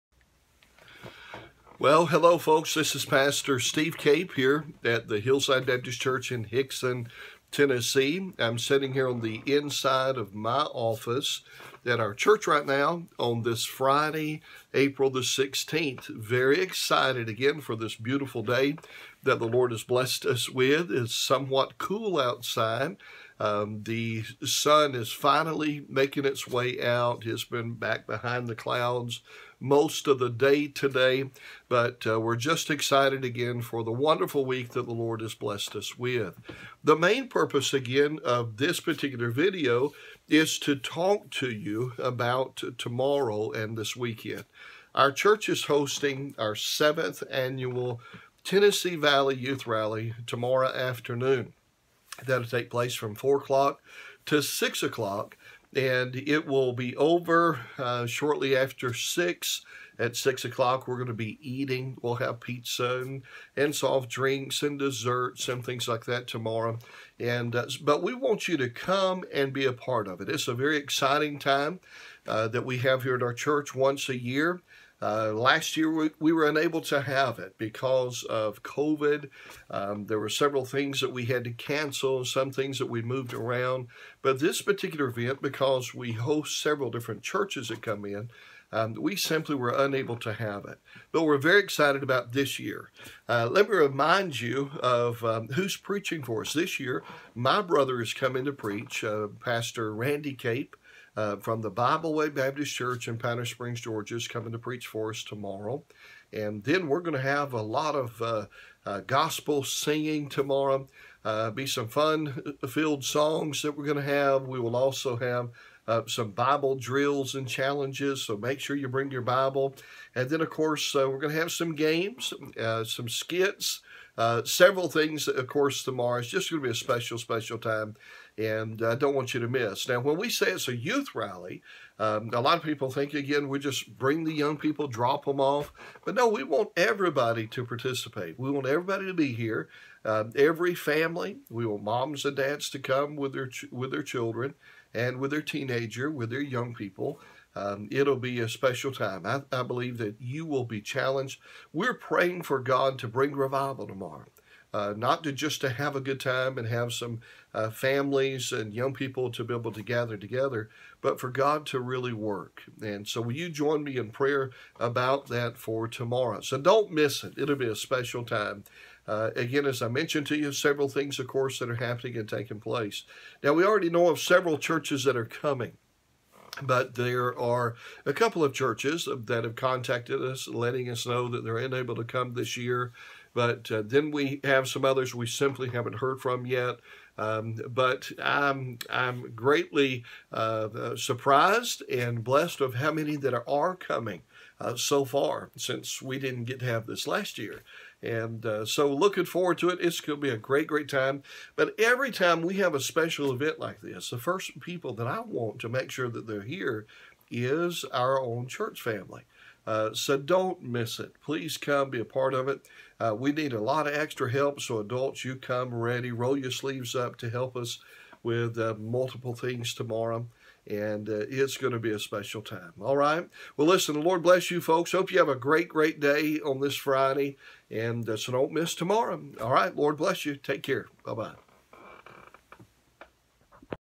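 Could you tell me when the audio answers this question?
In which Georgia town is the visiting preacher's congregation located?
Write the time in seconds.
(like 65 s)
103 s.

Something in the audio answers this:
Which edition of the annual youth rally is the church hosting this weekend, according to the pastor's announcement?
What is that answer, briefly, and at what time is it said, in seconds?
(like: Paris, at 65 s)
7th, at 46 s.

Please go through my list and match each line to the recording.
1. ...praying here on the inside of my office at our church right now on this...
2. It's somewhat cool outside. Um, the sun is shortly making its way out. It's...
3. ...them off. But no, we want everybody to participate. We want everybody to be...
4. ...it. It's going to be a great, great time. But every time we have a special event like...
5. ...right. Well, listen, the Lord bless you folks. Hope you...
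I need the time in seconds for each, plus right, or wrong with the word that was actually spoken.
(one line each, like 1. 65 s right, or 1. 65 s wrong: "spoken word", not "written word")
1. 8 s wrong: "sitting", not "praying"
2. 20 s wrong: "finally", not "shortly"
3. 135 s right
4. 199 s right
5. 222 s right.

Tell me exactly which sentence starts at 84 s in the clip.
But this particular event, because we host several different churches that come in, um, we simply were unable to have it.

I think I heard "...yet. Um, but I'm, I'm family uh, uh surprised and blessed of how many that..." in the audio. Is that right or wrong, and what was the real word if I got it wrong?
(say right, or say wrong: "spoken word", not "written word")
wrong: "greatly", not "family".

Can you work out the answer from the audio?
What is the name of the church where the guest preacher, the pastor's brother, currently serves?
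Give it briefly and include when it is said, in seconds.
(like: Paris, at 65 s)
Bible Way Baptist Church, at 101 s.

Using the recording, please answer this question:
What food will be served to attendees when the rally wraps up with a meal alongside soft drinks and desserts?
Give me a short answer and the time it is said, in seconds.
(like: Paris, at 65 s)
Pizza, at 62 s.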